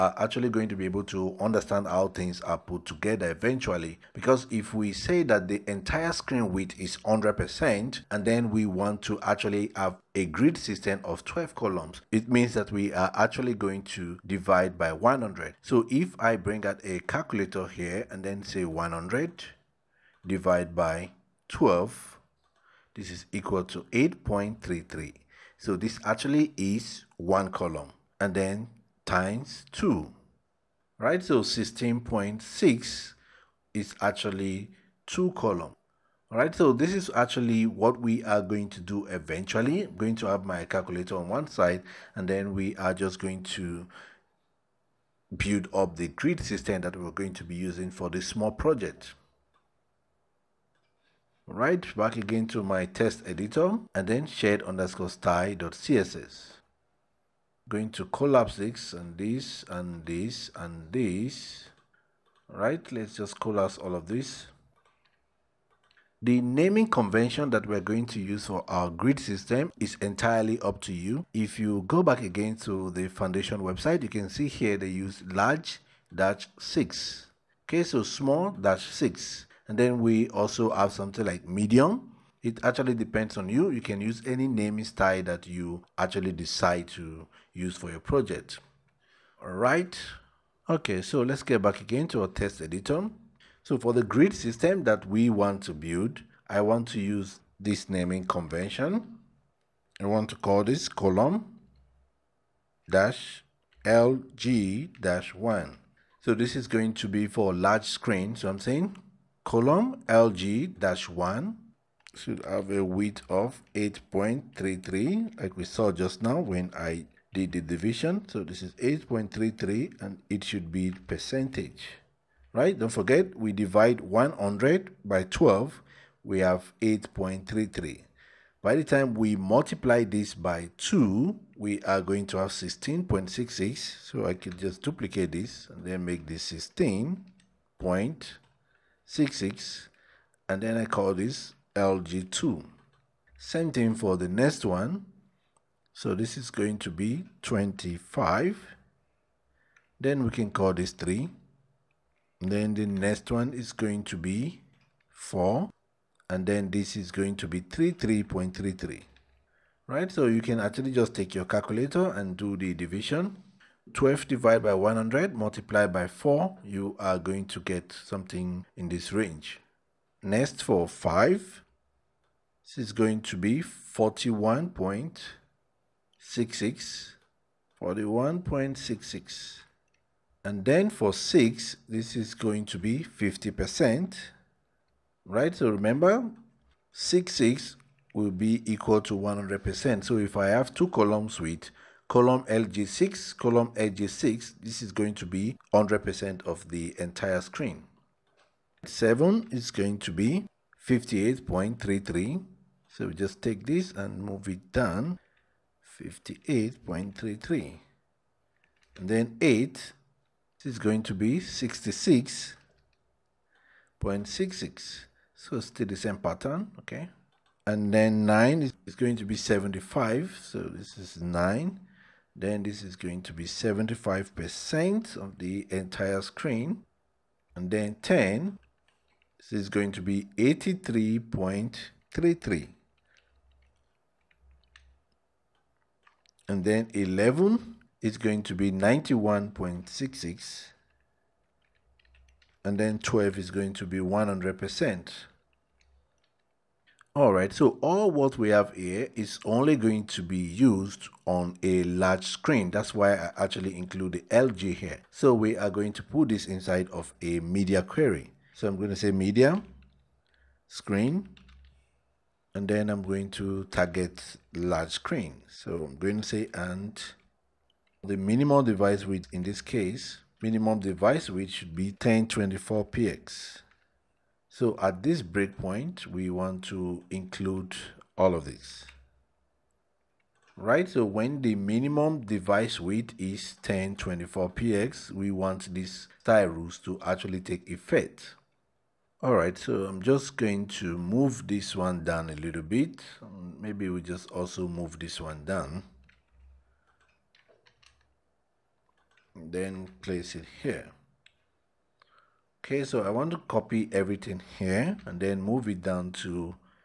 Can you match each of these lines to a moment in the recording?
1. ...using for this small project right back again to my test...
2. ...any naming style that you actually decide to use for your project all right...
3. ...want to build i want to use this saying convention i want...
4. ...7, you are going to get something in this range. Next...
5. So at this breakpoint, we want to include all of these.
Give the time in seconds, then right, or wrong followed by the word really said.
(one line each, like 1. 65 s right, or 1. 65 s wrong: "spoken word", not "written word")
1. 47 s right
2. 84 s right
3. 95 s wrong: "naming", not "saying"
4. 166 s wrong: "4", not "7"
5. 274 s right.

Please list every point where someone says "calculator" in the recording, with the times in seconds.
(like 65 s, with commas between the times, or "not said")
16 s, 40 s, 161 s.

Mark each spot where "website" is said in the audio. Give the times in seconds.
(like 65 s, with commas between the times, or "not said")
73 s.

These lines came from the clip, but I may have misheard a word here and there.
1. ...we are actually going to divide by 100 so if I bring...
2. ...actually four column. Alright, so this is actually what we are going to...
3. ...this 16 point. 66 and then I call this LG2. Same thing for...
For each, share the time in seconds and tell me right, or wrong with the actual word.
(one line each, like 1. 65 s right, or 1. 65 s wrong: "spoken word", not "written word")
1. 12 s right
2. 34 s wrong: "two", not "four"
3. 136 s right.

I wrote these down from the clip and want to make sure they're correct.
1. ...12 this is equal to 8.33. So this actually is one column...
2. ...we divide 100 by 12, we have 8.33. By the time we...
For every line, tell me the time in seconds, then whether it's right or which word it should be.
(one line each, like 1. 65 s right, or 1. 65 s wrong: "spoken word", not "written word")
1. 21 s right
2. 123 s right.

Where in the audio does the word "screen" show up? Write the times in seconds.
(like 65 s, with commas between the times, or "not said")
6 s, 107 s, 197 s, 226 s, 252 s, 260 s, 264 s.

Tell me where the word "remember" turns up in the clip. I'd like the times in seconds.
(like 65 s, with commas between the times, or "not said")
185 s.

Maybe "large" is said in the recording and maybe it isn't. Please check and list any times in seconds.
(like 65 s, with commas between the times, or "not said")
75 s, 107 s, 251 s, 264 s.